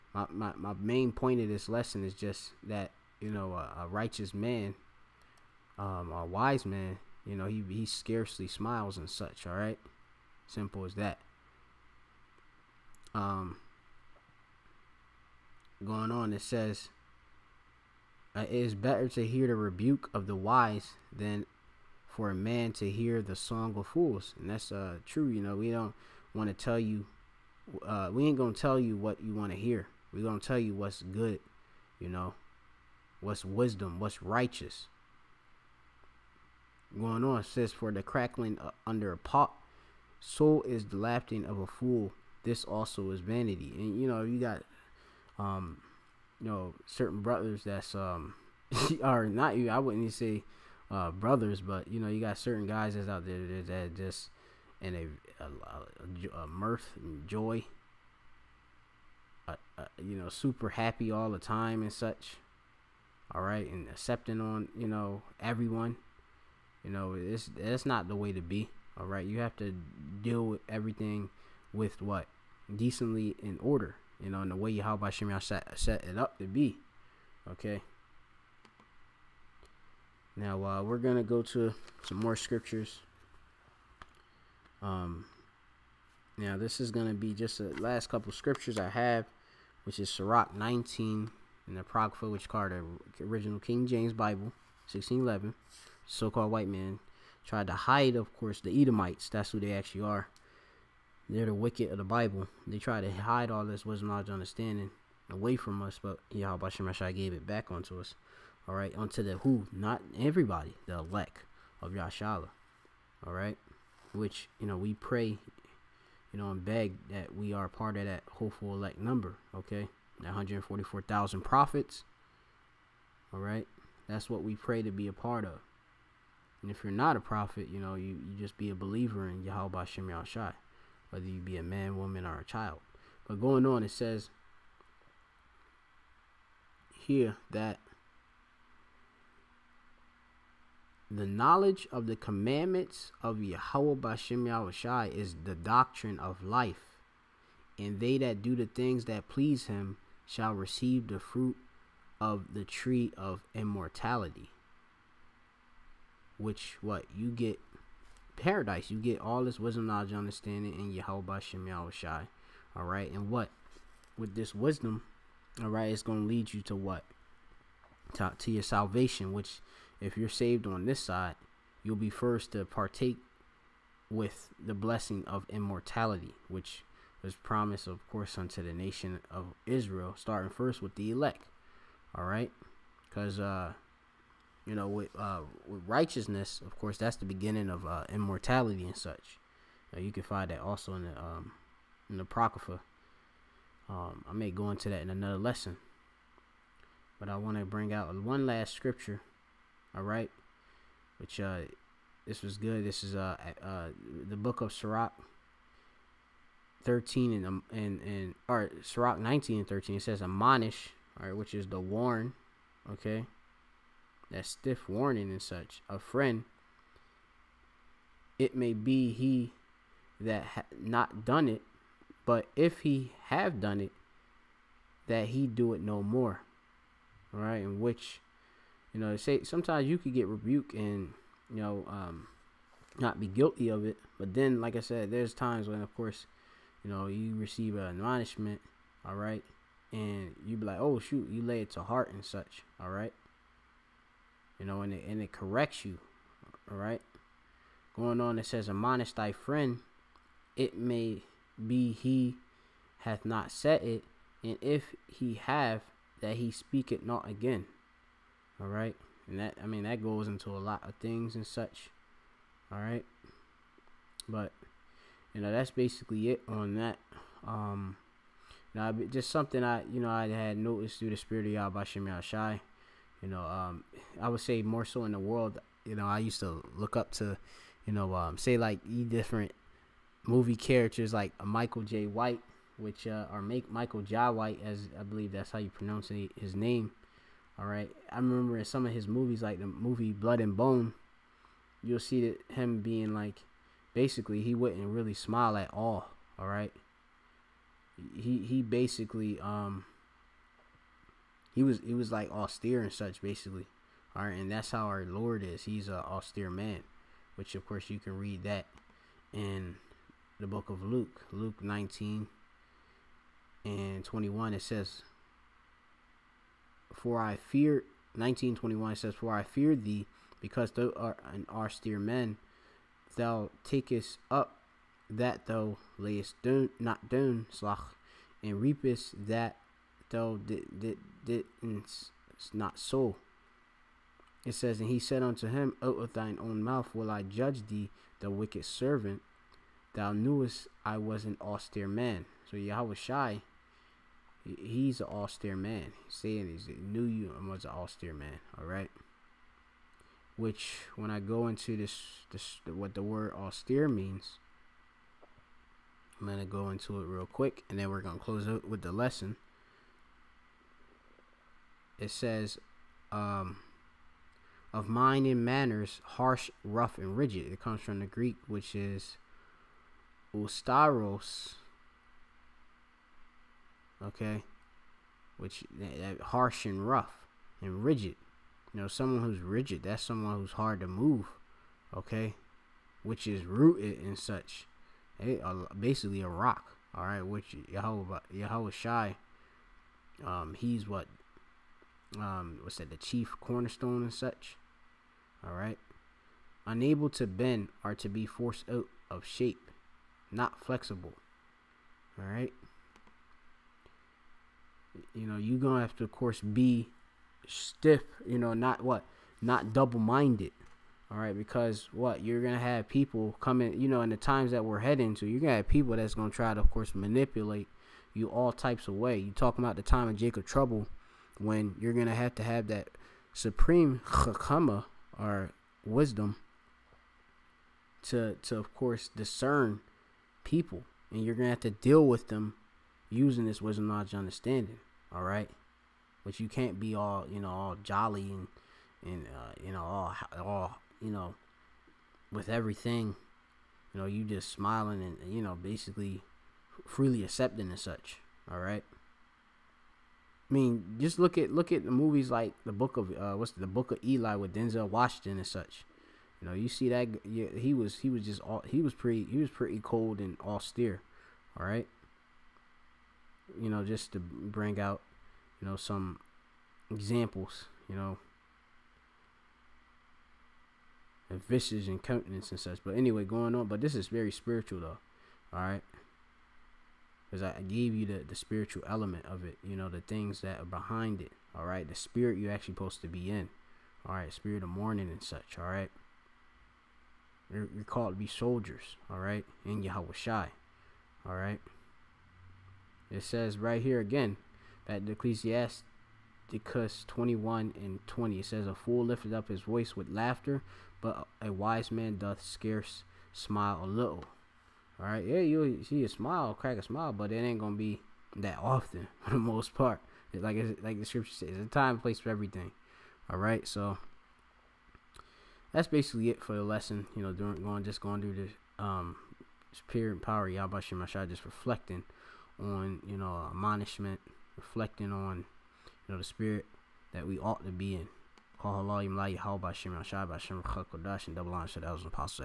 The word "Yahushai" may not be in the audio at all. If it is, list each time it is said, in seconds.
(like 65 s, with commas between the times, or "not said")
144 s, 161 s.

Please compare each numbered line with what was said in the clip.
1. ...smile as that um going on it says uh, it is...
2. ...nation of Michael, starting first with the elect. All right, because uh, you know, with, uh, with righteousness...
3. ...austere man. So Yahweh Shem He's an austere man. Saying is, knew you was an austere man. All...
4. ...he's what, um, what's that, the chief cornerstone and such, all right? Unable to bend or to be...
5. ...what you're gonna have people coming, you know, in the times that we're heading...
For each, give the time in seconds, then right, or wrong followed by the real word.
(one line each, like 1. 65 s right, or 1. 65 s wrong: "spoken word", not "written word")
1. 10 s wrong: "simple", not "smile"
2. 178 s wrong: "Israel", not "Michael"
3. 341 s wrong: "Shai", not "Shem"
4. 390 s right
5. 411 s right.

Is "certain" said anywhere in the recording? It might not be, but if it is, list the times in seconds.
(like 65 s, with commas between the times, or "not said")
46 s, 52 s.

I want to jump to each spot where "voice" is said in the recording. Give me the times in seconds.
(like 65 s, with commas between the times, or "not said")
499 s.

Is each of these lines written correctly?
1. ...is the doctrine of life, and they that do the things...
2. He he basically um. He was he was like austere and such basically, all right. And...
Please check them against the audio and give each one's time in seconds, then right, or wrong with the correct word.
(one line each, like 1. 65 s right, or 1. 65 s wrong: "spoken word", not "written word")
1. 145 s right
2. 298 s right.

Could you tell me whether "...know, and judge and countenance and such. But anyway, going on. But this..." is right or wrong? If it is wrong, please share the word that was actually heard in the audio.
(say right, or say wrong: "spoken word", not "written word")
wrong: "visage", not "judge".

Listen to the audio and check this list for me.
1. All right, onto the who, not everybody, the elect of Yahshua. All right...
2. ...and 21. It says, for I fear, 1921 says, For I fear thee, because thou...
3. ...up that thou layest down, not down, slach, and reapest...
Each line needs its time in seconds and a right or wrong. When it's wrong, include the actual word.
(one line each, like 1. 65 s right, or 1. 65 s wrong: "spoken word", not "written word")
1. 108 s right
2. 313 s right
3. 324 s right.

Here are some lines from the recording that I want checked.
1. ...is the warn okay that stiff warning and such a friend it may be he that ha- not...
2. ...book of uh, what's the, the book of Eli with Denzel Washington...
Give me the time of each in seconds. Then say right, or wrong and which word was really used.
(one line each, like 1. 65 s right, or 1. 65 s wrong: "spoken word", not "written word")
1. 211 s right
2. 452 s right.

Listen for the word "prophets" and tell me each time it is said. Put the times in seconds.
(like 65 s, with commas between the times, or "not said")
121 s, 127 s.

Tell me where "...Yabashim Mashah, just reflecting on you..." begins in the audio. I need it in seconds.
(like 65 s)
520 s.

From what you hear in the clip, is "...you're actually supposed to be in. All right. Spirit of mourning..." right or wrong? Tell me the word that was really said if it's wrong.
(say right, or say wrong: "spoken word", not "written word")
right.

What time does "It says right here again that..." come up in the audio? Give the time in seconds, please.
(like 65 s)
493 s.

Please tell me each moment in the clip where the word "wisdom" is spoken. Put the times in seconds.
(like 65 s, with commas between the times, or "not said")
33 s, 103 s, 159 s, 164 s, 425 s, 433 s.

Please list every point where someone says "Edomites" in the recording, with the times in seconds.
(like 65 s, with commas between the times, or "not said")
98 s.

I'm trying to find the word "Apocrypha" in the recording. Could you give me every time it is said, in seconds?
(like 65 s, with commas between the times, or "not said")
91 s, 192 s.